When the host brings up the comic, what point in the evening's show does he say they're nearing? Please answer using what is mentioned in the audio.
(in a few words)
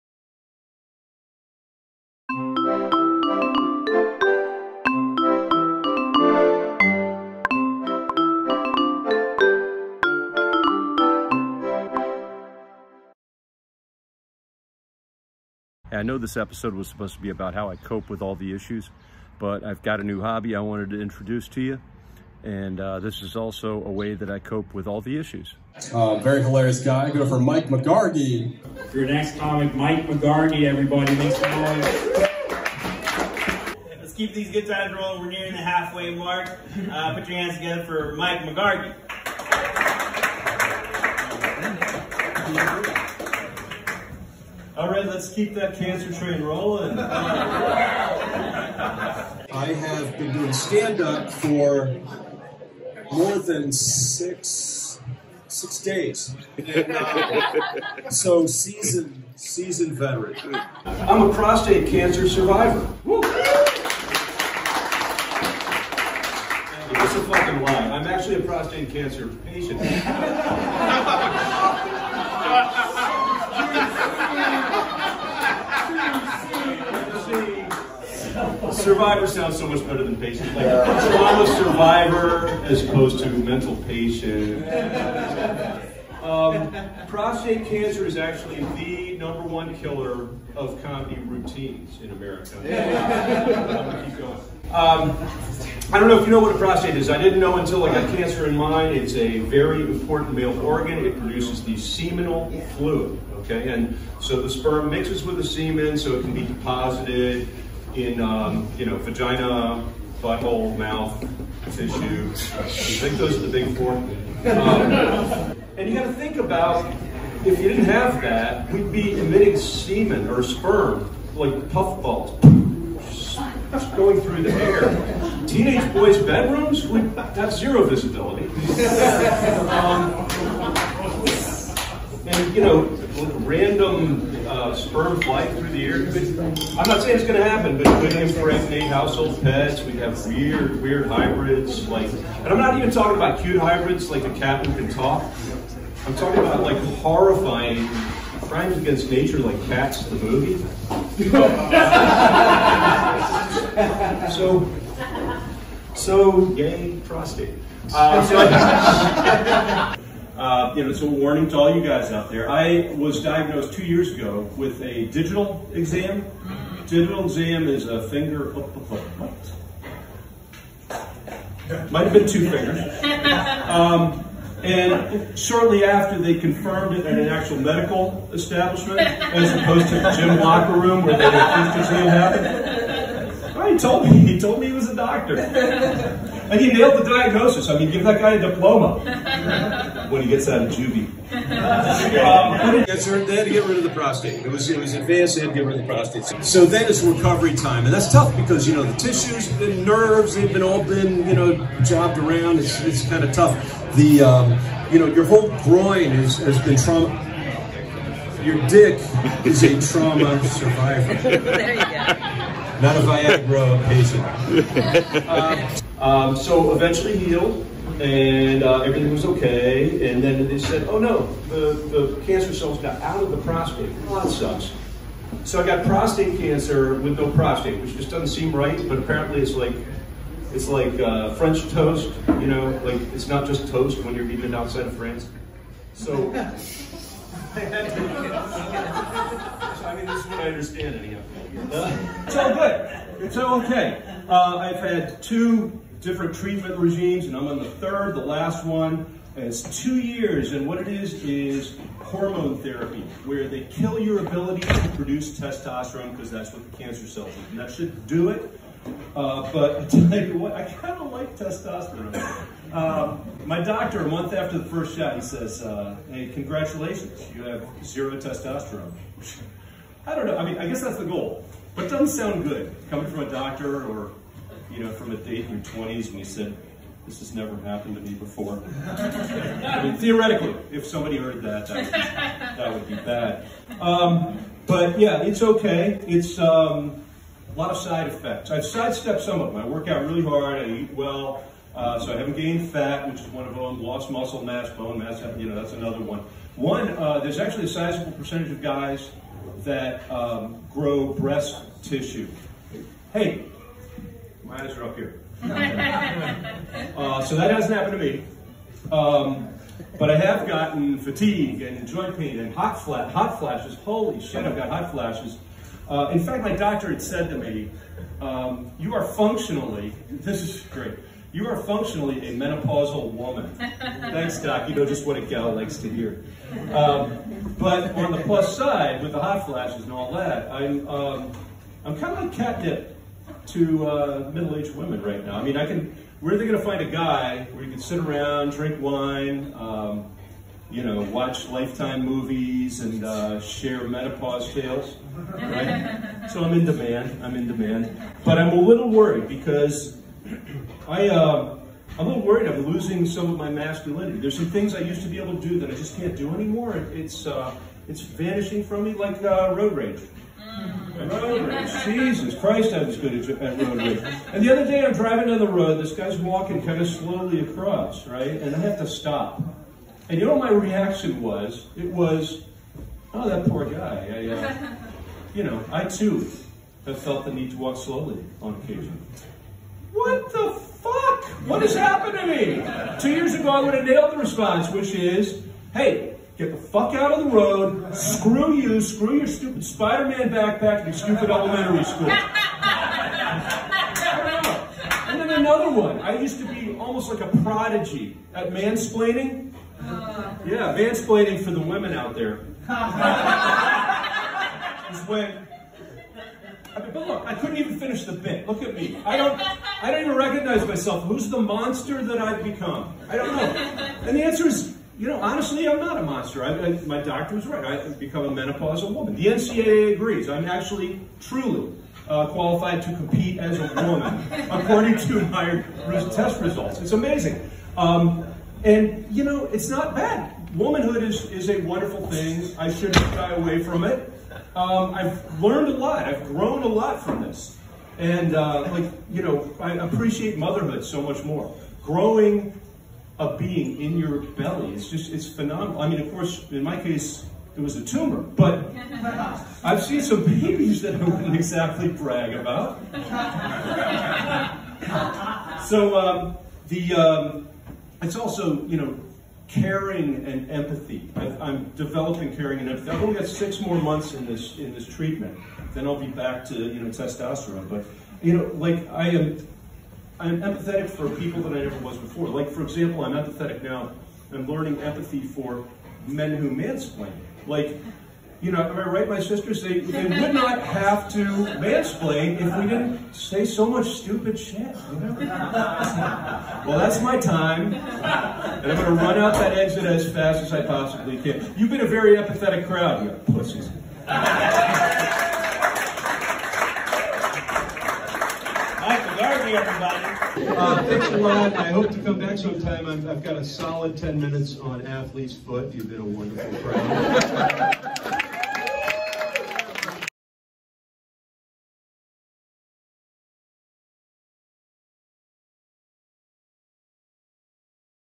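halfway mark.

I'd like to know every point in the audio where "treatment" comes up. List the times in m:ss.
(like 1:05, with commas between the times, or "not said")
4:06, 7:44.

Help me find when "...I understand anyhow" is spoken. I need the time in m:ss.
4:00.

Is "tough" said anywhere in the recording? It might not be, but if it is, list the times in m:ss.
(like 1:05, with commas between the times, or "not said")
3:18, 3:23.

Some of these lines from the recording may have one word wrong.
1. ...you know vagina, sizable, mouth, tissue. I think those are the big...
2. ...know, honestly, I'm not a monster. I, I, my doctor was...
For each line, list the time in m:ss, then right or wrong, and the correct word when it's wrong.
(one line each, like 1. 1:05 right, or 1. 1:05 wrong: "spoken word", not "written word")
1. 1:48 wrong: "butthole", not "sizable"
2. 6:55 right.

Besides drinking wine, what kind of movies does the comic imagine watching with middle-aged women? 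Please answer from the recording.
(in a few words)
Lifetime movies.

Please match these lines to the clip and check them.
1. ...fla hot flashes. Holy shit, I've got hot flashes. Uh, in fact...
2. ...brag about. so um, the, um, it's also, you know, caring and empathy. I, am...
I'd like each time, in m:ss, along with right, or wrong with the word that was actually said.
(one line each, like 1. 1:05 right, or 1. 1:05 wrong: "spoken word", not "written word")
1. 5:12 right
2. 7:31 right.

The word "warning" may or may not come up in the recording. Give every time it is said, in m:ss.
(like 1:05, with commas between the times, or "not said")
2:41.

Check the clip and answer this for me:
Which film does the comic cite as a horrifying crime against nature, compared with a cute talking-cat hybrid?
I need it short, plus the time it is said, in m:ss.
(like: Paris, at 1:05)
Cats, the movie, at 2:29.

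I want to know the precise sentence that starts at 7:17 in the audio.
And, uh, like, you know, I appreciate motherhood so much more.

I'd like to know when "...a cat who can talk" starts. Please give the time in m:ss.
2:24.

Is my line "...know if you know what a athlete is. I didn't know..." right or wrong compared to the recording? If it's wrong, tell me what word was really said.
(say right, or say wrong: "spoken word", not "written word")
wrong: "prostate", not "athlete".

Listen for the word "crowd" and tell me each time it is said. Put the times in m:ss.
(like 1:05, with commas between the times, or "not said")
8:12, 8:26.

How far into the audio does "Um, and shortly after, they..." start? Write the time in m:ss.
2:53.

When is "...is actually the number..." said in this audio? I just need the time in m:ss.
1:28.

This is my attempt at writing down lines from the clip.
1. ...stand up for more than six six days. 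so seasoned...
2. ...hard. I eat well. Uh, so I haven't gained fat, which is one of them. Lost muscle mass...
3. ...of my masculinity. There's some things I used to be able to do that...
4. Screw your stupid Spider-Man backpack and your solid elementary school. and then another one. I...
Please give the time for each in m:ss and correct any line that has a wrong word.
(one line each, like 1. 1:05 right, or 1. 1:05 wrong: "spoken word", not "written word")
1. 0:50 right
2. 4:50 right
3. 5:53 right
4. 6:28 wrong: "stupid", not "solid".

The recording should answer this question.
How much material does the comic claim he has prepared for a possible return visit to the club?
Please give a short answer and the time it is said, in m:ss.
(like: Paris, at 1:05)
10 minutes, at 8:23.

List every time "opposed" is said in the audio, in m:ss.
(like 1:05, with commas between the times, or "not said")
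1:22, 2:59.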